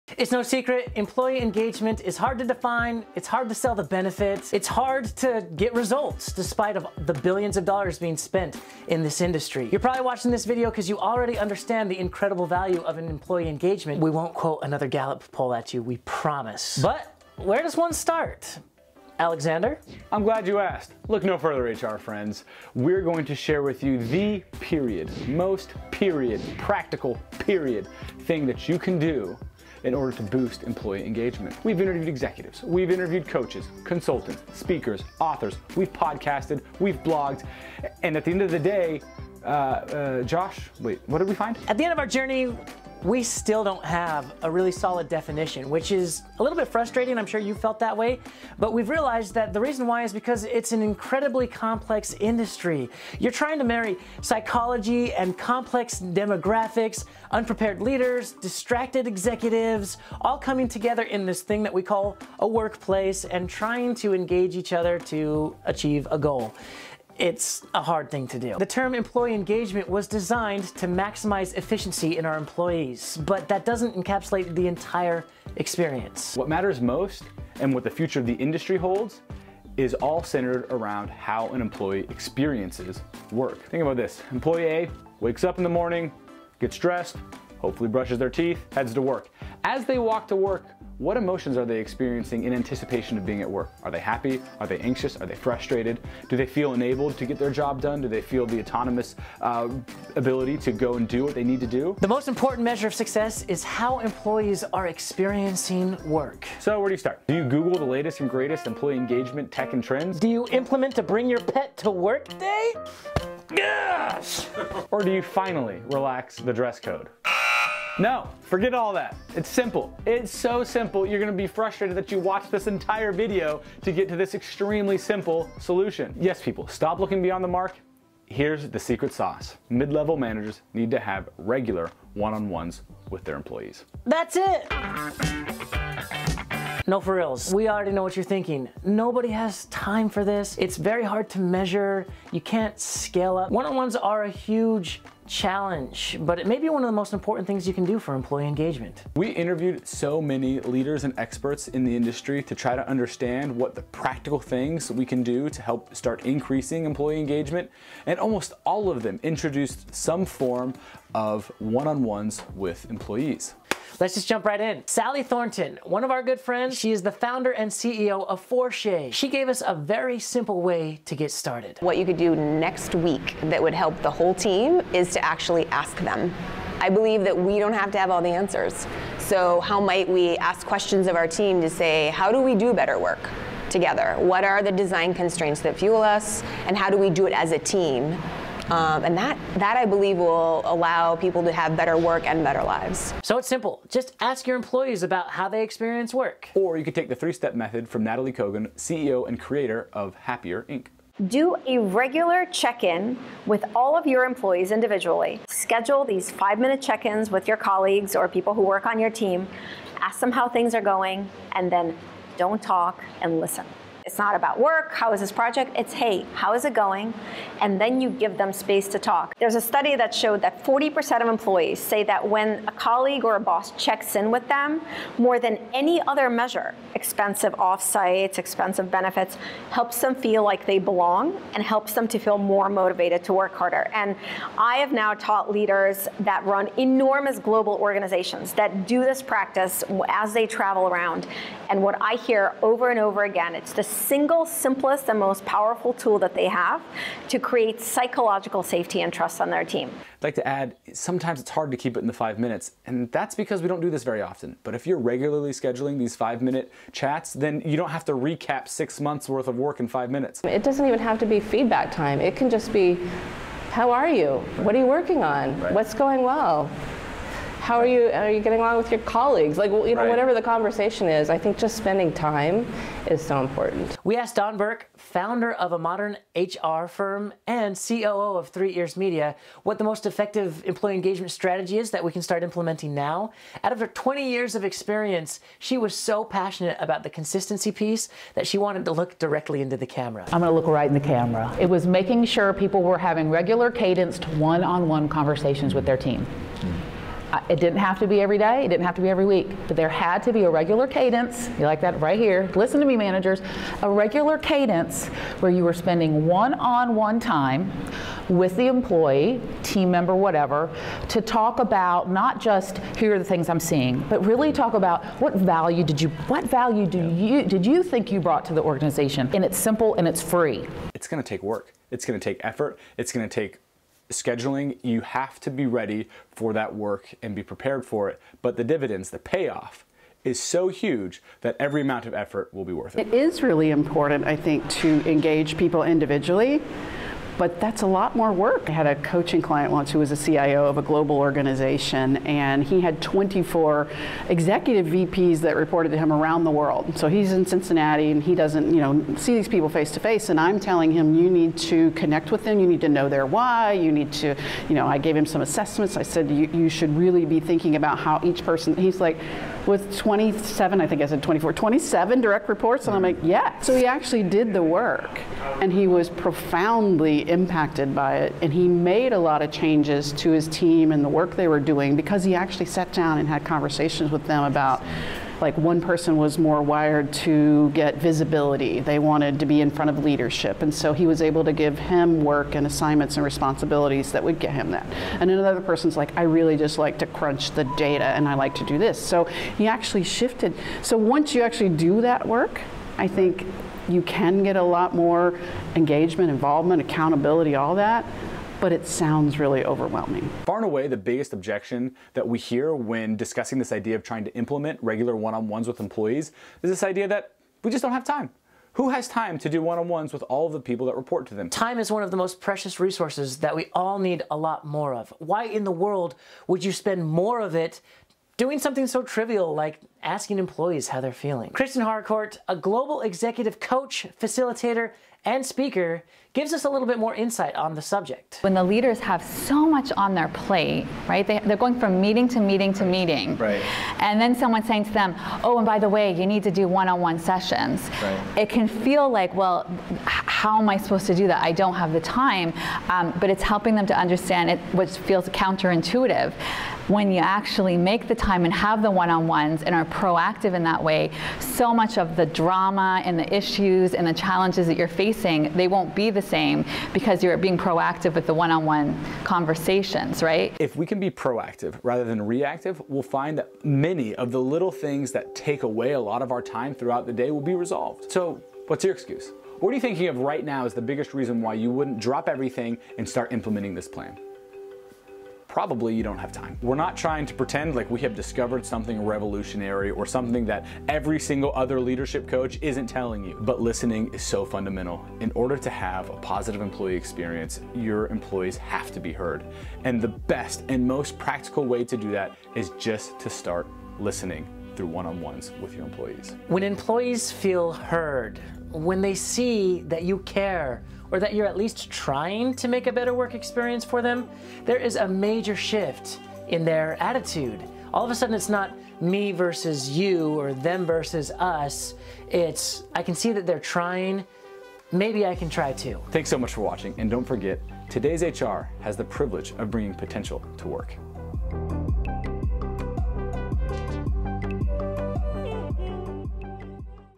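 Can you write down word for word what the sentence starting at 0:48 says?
But we've realized that the reason why is because it's an incredibly complex industry.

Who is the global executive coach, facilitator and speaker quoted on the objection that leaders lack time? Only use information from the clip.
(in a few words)
Kristen Harcourt.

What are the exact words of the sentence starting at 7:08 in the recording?
When the leaders have so much on their plate, right?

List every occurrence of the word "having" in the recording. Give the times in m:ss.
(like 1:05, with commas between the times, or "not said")
4:52.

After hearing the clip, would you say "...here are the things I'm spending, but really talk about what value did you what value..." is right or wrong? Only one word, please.
wrong.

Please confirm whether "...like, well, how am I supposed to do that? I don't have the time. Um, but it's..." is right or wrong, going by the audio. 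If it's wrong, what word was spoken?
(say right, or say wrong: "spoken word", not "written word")
right.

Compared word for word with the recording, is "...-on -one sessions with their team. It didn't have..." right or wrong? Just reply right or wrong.
wrong.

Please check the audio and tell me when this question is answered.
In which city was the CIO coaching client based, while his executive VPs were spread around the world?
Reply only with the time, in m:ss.
5:47.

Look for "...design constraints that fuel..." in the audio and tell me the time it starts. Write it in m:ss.
3:04.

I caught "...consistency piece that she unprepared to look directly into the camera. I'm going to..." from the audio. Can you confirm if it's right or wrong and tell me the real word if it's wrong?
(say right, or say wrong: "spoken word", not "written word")
wrong: "wanted", not "unprepared".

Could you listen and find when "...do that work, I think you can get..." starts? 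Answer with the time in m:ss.
6:31.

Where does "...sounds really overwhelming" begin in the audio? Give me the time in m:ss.
6:38.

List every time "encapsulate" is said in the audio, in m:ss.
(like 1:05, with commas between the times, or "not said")
1:13.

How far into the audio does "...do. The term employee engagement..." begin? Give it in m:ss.
1:08.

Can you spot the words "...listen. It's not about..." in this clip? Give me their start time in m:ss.
3:33.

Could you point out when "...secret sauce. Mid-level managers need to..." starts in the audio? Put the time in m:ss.
2:08.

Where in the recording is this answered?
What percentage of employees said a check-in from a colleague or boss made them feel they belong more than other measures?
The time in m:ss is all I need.
3:40.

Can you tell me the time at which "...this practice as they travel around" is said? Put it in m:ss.
3:59.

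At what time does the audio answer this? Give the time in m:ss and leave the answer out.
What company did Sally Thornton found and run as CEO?
2:48.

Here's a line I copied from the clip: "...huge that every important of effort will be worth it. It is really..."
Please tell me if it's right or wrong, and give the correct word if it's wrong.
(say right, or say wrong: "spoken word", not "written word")
wrong: "amount", not "important".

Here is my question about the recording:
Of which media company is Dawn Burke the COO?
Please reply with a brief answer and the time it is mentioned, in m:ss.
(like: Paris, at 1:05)
Three Ears Media, at 4:38.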